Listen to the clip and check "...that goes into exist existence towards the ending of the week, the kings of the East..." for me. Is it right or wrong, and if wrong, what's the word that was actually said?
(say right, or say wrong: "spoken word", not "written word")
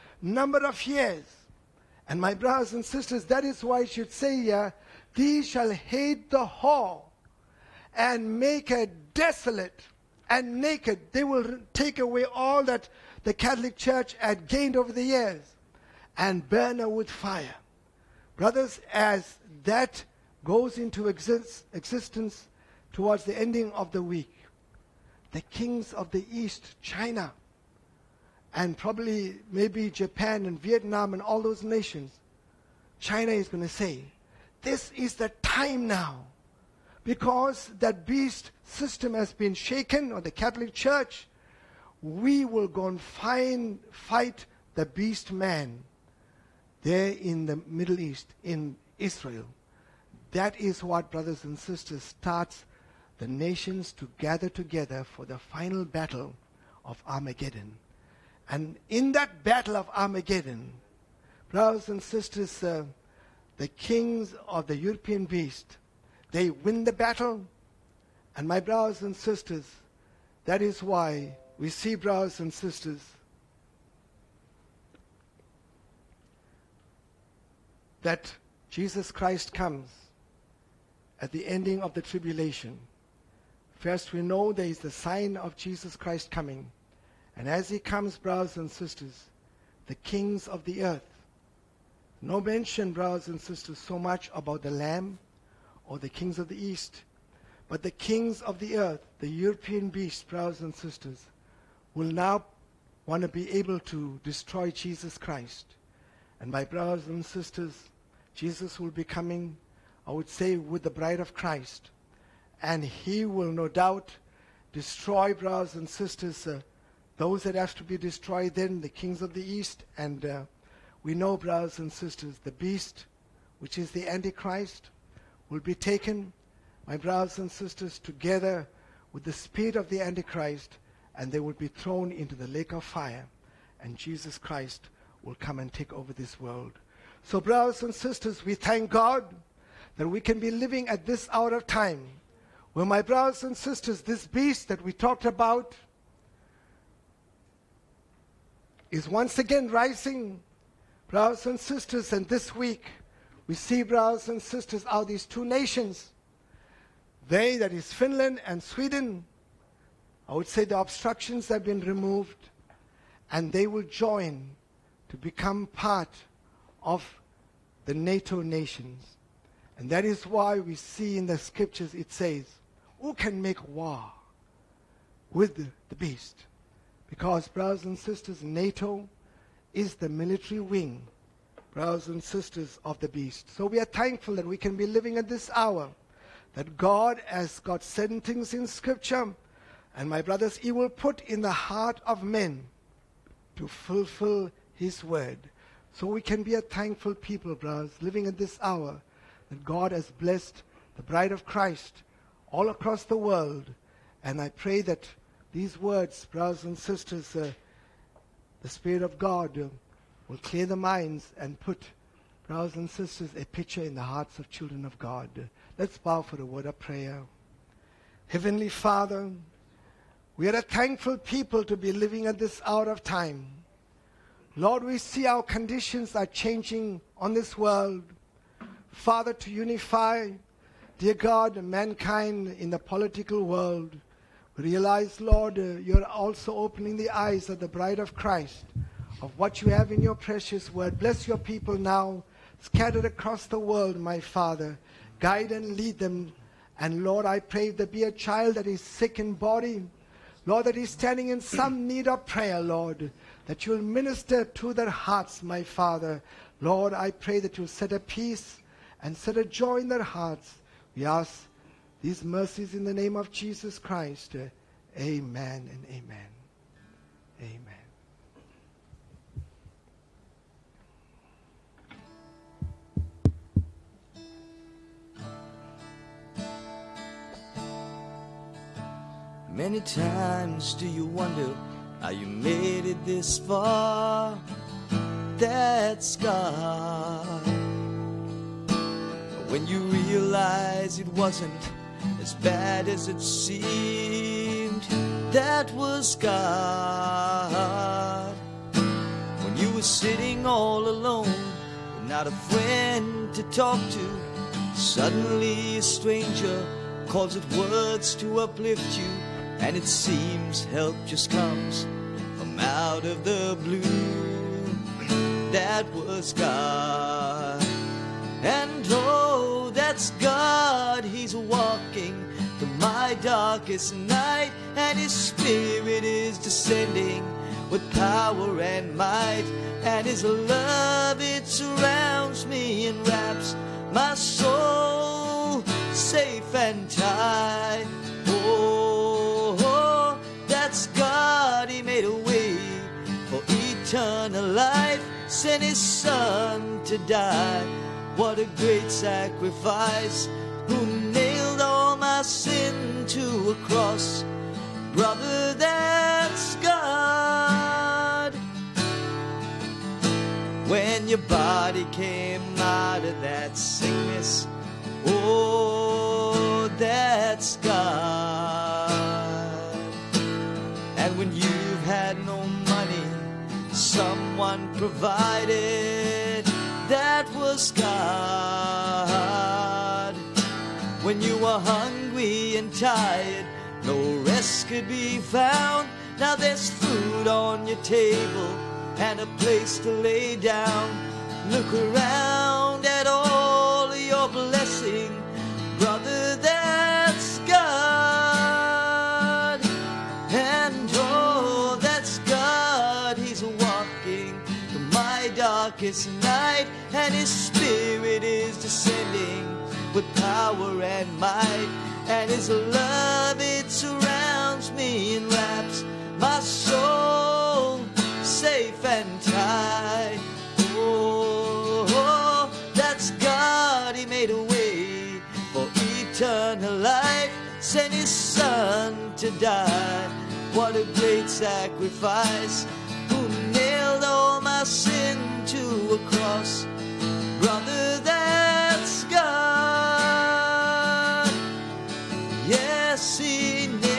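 right.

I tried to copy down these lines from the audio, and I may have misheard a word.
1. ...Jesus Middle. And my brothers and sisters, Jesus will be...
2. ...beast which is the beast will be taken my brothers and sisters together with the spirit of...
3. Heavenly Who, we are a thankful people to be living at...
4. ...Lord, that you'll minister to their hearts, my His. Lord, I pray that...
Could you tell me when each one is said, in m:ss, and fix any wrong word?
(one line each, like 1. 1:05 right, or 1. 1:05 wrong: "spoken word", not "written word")
1. 1:44 wrong: "Christ", not "Middle"
2. 2:02 wrong: "antichrist", not "beast"
3. 3:38 wrong: "Father", not "Who"
4. 4:12 wrong: "Father", not "His".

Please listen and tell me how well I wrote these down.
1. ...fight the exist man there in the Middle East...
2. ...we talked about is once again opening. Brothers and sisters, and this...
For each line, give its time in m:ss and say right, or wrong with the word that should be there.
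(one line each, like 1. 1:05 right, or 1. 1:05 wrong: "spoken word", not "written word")
1. 0:43 wrong: "beast", not "exist"
2. 2:24 wrong: "rising", not "opening".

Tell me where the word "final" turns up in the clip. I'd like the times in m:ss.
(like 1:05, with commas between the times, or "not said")
0:55.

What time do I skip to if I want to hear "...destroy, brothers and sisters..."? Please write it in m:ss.
1:54.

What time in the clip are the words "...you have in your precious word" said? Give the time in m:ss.
3:59.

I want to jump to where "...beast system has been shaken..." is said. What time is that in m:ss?
0:38.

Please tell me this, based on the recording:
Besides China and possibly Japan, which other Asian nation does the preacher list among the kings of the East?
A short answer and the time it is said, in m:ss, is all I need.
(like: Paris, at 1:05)
Vietnam, at 0:30.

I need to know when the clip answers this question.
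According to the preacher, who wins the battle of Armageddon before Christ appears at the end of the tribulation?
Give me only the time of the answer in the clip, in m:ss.
1:03.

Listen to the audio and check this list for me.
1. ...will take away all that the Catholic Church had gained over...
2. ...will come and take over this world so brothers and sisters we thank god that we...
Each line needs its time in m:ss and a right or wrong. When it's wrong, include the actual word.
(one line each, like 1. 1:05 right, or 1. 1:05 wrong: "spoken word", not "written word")
1. 0:11 right
2. 2:15 right.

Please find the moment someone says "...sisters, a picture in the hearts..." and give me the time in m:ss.
3:32.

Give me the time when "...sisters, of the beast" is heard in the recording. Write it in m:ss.
3:02.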